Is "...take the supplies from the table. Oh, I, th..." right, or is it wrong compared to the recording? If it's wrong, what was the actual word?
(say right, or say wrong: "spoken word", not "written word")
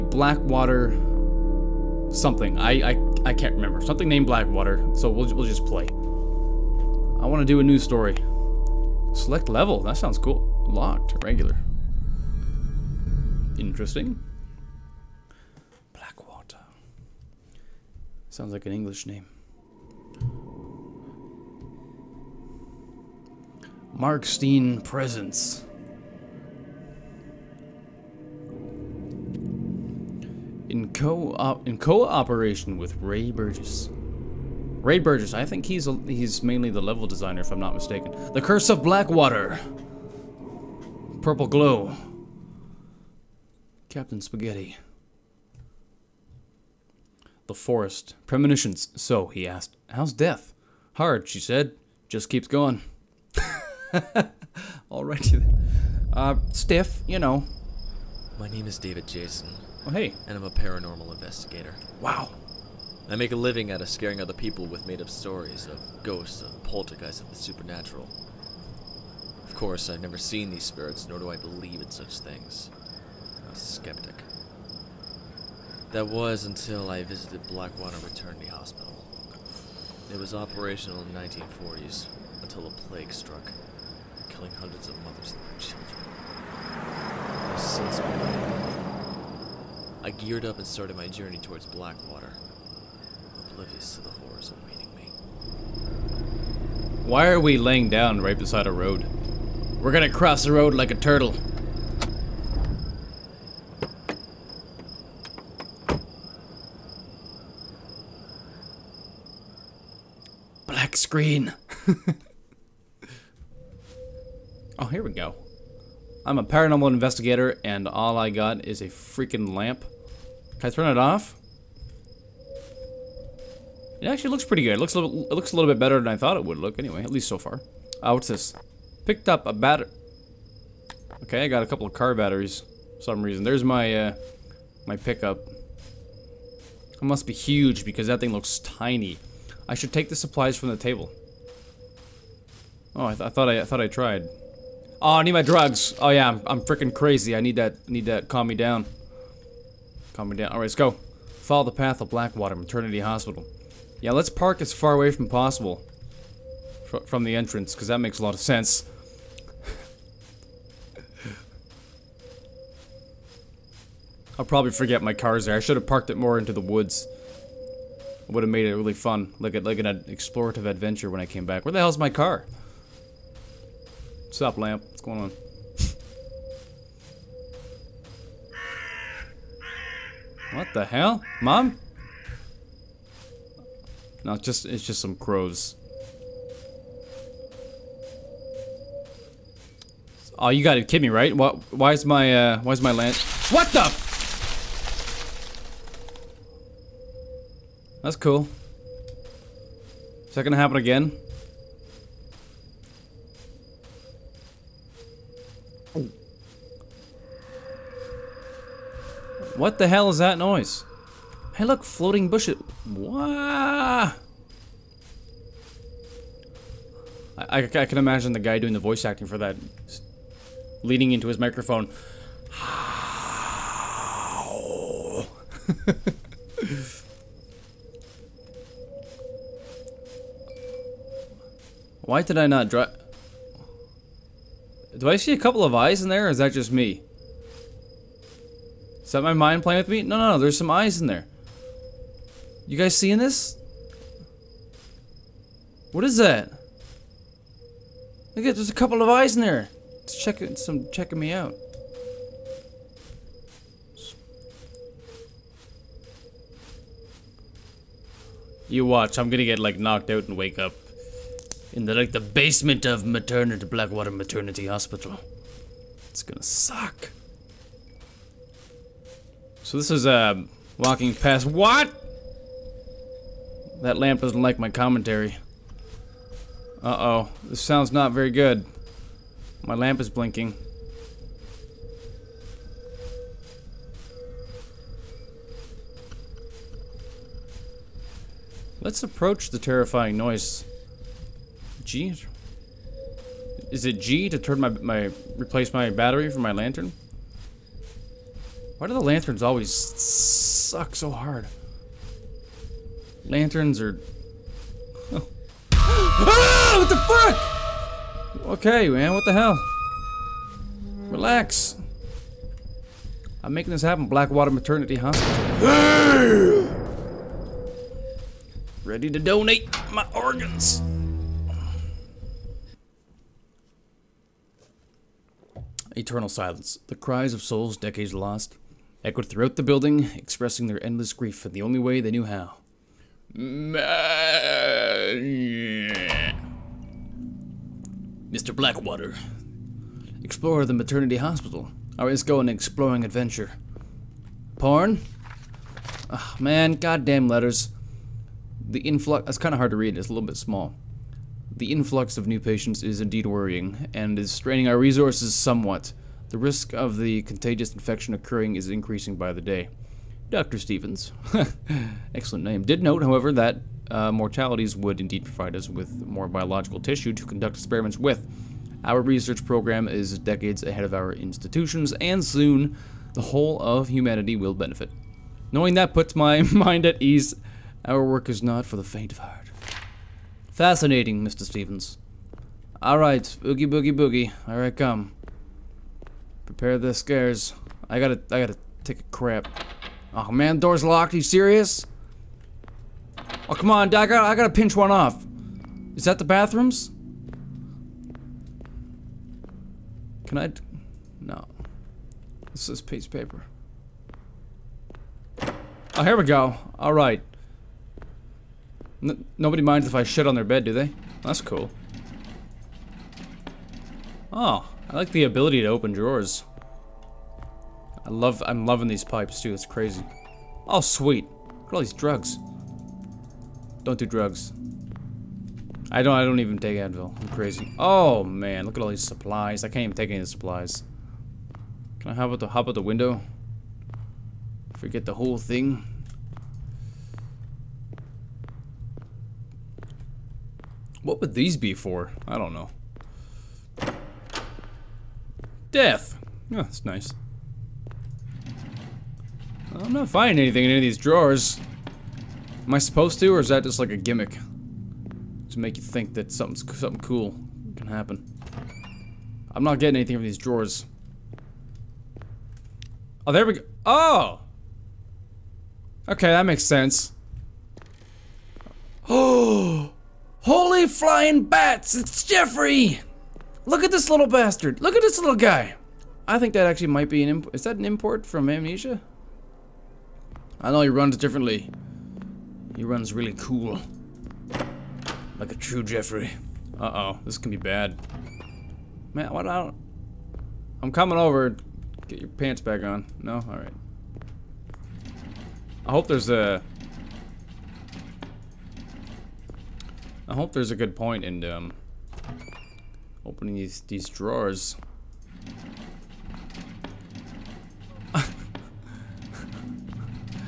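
right.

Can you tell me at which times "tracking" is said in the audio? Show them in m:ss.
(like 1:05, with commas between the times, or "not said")
not said.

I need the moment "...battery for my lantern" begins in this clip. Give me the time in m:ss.
4:55.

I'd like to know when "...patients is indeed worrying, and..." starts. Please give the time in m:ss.
5:52.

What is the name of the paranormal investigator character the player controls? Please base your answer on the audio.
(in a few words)
David Jason.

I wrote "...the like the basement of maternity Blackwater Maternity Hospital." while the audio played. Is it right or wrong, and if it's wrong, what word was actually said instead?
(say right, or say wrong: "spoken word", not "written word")
right.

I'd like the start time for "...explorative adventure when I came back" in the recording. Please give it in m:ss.
2:50.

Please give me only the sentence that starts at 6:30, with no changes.
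Oh man, door's locked, Are you serious?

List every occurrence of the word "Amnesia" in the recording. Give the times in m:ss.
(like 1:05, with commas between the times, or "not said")
7:58.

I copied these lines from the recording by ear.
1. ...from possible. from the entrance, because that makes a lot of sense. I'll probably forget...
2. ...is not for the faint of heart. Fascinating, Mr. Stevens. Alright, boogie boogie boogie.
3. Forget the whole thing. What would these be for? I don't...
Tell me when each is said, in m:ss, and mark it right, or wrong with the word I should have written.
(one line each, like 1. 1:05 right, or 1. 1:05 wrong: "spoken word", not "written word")
1. 2:35 right
2. 6:18 right
3. 7:14 right.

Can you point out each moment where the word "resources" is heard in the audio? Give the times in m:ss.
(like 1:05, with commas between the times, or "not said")
5:54.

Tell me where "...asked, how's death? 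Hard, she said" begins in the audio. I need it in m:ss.
0:49.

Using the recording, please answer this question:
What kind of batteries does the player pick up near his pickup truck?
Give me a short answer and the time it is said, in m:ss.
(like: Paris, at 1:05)
Car batteries, at 2:11.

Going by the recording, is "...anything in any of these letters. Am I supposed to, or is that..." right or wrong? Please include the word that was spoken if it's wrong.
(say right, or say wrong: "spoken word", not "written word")
wrong: "drawers", not "letters".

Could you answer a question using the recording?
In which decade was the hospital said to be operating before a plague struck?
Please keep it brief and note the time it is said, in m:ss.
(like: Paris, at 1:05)
1940s, at 1:21.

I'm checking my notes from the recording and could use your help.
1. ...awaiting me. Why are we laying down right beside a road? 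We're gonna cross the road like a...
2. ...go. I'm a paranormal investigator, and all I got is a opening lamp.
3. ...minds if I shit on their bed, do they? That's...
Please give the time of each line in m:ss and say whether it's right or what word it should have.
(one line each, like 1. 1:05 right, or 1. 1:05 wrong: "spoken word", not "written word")
1. 1:34 right
2. 1:55 wrong: "freaking", not "opening"
3. 6:49 right.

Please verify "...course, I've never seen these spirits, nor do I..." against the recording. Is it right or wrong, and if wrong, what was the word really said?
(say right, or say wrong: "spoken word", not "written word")
right.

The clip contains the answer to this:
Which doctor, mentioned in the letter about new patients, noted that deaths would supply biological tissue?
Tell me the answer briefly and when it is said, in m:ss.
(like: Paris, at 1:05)
Dr. Stevens, at 6:00.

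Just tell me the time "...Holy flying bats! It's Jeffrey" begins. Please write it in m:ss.
7:50.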